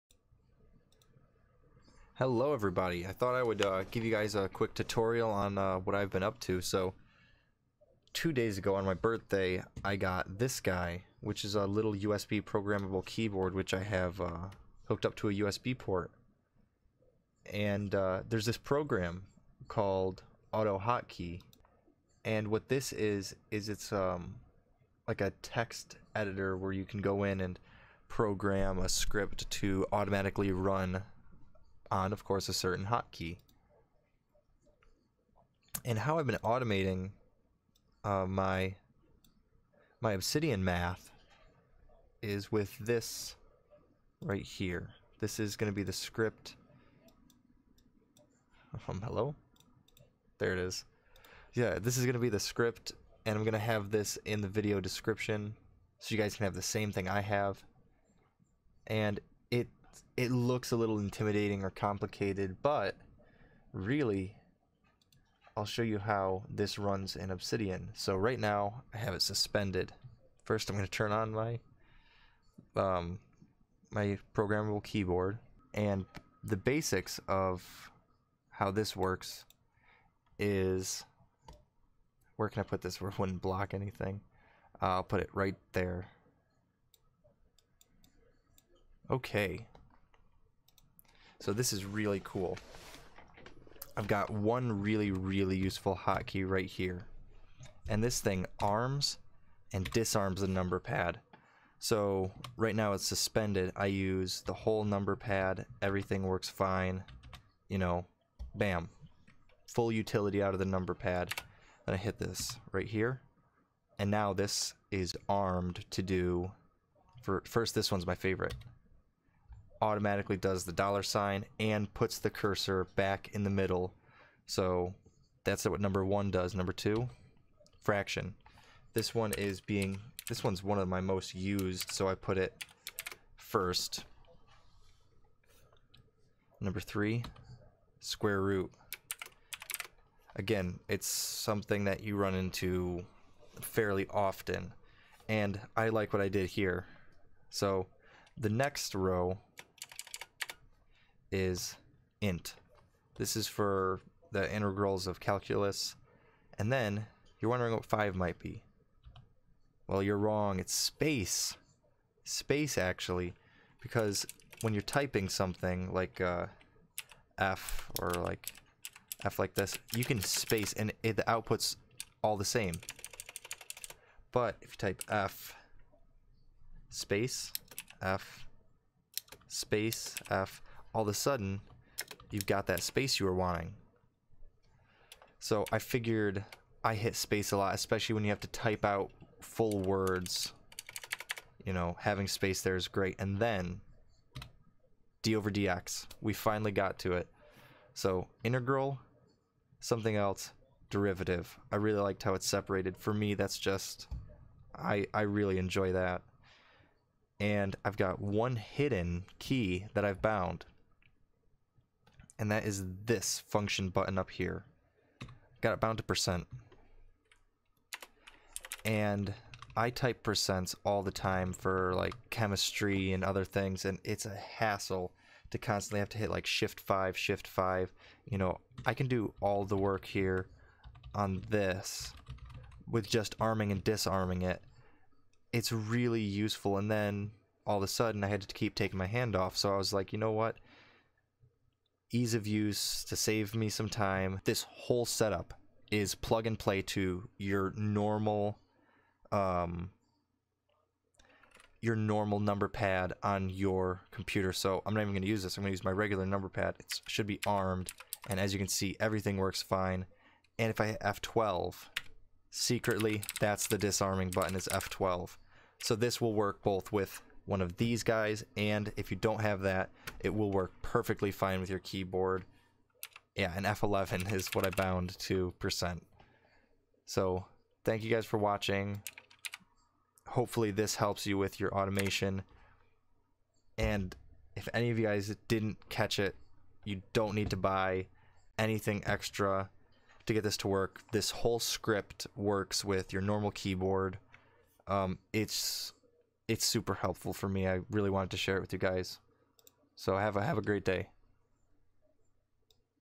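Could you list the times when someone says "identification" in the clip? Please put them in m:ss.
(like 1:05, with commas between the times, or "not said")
not said.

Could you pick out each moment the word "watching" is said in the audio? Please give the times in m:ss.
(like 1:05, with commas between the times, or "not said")
4:38.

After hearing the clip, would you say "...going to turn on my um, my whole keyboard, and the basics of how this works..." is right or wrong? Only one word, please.
wrong.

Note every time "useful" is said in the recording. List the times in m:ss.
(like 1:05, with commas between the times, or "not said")
1:35, 3:56.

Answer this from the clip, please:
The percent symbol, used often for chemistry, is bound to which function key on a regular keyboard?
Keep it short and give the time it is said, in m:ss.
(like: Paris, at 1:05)
F11, at 4:33.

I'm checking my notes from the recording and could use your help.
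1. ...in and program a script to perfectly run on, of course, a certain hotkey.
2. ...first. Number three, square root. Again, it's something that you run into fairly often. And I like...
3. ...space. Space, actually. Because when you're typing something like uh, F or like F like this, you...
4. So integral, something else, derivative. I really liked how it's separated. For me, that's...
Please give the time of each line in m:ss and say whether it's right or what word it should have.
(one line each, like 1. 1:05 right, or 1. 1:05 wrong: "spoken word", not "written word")
1. 0:27 wrong: "automatically", not "perfectly"
2. 2:13 right
3. 2:40 right
4. 3:17 right.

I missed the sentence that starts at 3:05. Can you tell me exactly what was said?
So I figured I hit space a lot, especially when you have to type out full words.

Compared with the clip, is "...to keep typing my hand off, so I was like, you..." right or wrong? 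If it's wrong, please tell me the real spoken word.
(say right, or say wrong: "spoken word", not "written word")
wrong: "taking", not "typing".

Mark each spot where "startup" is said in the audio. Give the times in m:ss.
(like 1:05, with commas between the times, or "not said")
not said.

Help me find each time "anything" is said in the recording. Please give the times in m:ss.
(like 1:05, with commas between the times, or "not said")
1:23, 4:48.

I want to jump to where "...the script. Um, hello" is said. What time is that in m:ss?
0:45.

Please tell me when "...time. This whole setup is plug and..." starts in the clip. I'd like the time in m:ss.
4:03.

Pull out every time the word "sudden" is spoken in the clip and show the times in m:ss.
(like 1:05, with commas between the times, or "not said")
3:01, 3:57.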